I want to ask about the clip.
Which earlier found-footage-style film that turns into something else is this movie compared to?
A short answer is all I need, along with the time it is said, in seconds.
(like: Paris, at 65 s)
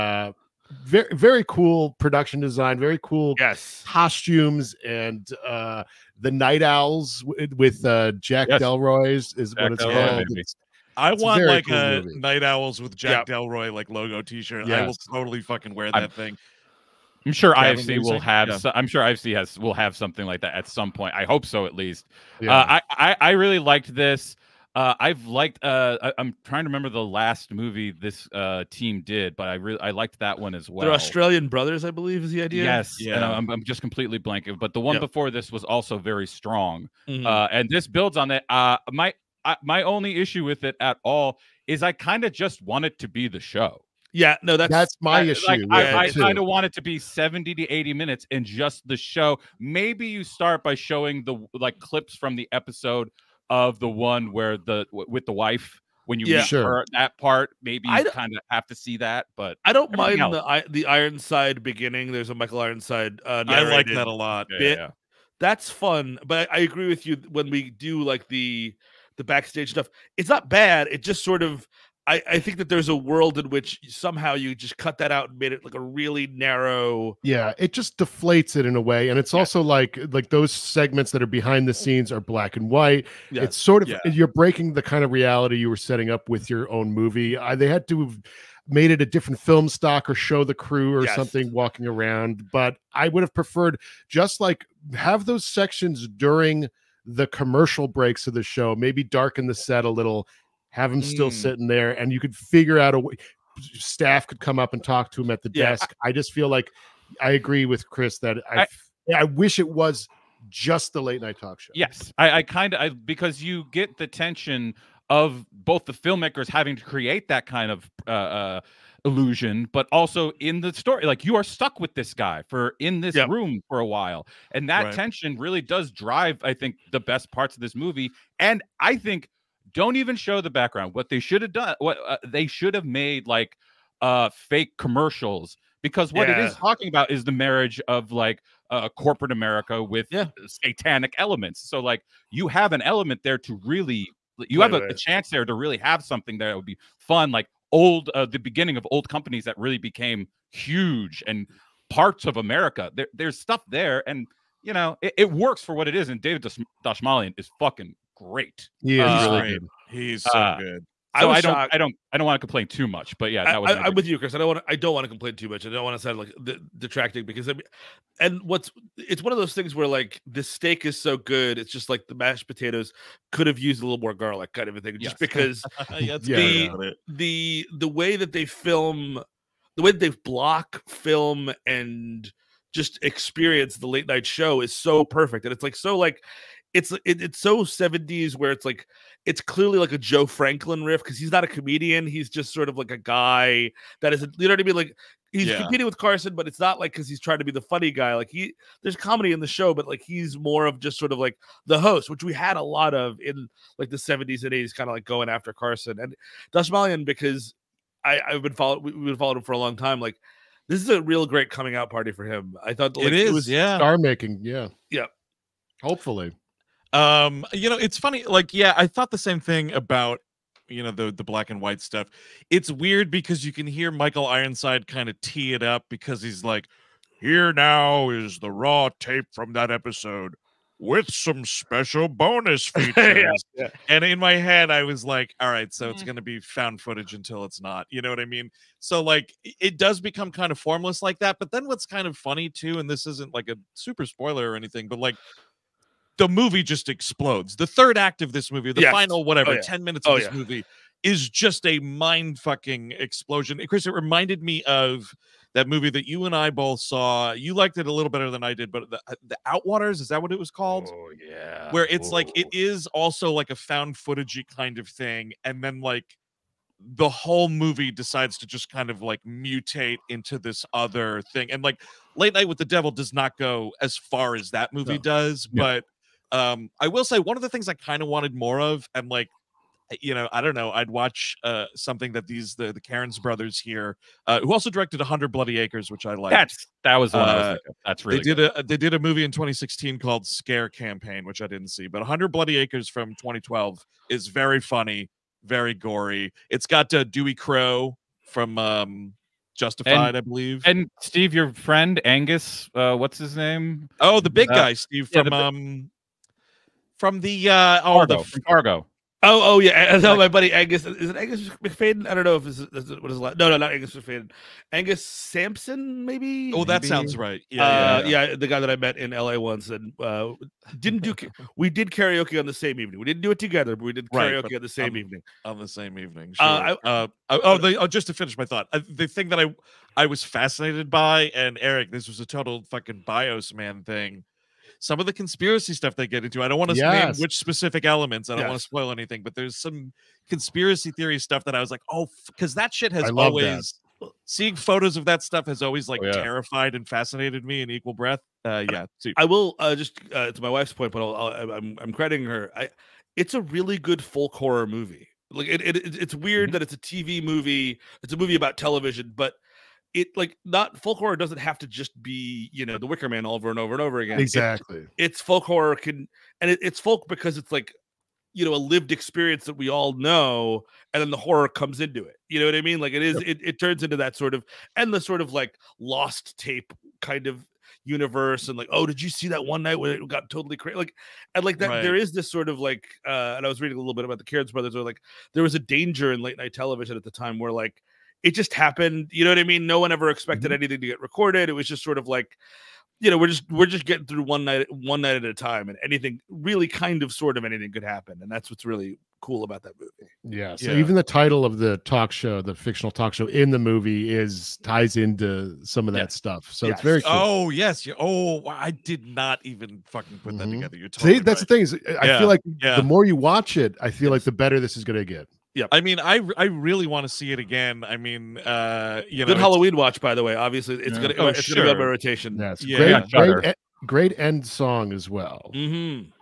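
The Outwaters, at 259 s.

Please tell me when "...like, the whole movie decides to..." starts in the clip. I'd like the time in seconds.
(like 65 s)
265 s.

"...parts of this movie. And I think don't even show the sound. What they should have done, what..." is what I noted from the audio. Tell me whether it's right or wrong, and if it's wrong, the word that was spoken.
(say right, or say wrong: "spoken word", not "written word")
wrong: "background", not "sound".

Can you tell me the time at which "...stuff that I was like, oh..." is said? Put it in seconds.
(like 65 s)
341 s.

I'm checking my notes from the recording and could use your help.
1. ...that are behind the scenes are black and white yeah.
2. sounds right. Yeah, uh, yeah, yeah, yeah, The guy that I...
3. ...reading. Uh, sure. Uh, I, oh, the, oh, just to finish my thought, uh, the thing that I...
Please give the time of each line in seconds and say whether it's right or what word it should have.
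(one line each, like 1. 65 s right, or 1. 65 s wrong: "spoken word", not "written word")
1. 81 s right
2. 316 s right
3. 325 s wrong: "evening", not "reading".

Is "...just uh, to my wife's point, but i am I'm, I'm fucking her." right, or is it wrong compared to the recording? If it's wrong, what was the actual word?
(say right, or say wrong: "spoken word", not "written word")
wrong: "crediting", not "fucking".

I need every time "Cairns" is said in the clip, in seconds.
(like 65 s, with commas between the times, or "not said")
282 s, 384 s.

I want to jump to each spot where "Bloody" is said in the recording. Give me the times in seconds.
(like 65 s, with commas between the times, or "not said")
285 s, 292 s.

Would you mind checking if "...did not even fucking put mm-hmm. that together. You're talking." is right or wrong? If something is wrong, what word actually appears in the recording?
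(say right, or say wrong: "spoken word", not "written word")
right.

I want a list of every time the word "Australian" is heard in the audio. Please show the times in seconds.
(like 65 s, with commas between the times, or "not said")
30 s.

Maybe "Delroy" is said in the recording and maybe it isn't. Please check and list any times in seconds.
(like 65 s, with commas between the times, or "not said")
8 s, 13 s.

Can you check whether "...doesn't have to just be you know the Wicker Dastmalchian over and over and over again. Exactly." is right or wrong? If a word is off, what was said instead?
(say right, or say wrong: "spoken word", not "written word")
wrong: "Man", not "Dastmalchian".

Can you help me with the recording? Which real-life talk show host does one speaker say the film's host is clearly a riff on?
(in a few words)
Joe Franklin.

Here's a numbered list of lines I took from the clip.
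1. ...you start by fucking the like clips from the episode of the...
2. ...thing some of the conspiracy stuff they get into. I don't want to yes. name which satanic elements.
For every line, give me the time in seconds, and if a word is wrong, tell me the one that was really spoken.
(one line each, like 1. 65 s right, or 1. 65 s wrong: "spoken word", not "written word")
1. 50 s wrong: "showing", not "fucking"
2. 333 s wrong: "specific", not "satanic".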